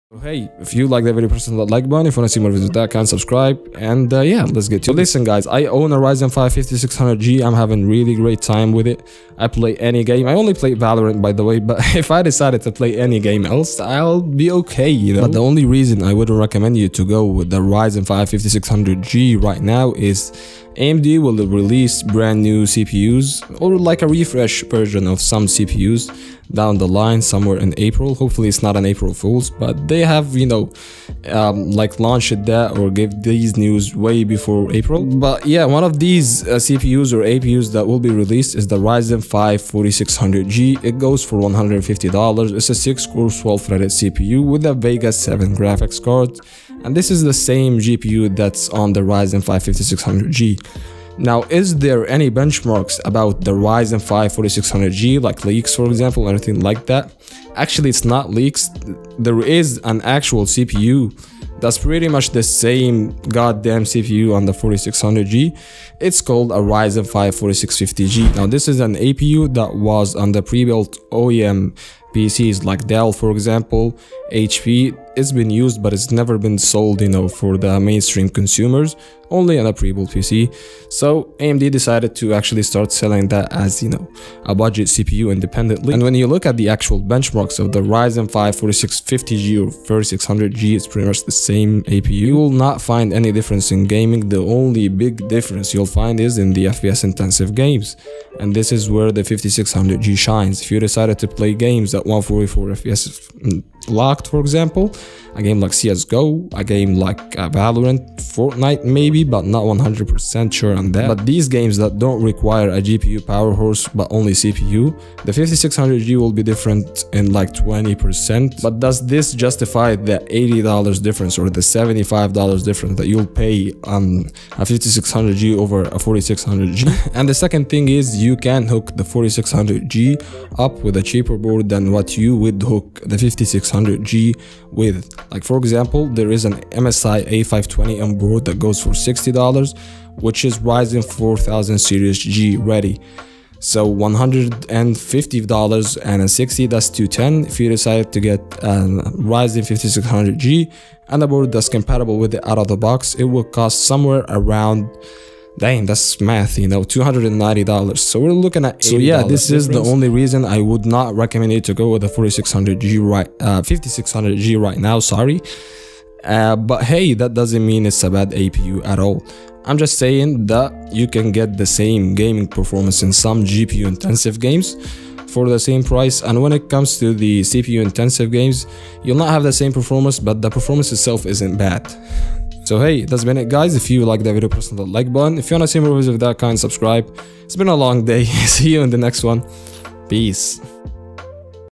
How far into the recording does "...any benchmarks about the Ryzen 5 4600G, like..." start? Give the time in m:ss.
0:52.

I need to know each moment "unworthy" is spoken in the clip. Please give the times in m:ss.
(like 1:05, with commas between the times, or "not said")
not said.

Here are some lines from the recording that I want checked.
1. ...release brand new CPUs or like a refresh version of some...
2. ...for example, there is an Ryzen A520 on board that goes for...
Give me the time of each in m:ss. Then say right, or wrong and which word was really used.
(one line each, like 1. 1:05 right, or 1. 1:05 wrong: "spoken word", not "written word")
1. 0:21 right
2. 2:15 wrong: "MSI", not "Ryzen".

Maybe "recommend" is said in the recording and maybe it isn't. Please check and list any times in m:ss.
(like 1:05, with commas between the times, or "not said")
0:16, 2:41.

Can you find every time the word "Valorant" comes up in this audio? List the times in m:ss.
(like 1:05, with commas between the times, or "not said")
0:10, 1:47.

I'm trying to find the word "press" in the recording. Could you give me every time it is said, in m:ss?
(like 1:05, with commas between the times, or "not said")
0:01, 3:04.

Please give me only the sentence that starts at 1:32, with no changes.
You will not find any difference in gaming.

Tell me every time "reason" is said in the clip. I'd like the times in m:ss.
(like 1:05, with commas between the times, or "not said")
0:15, 2:40.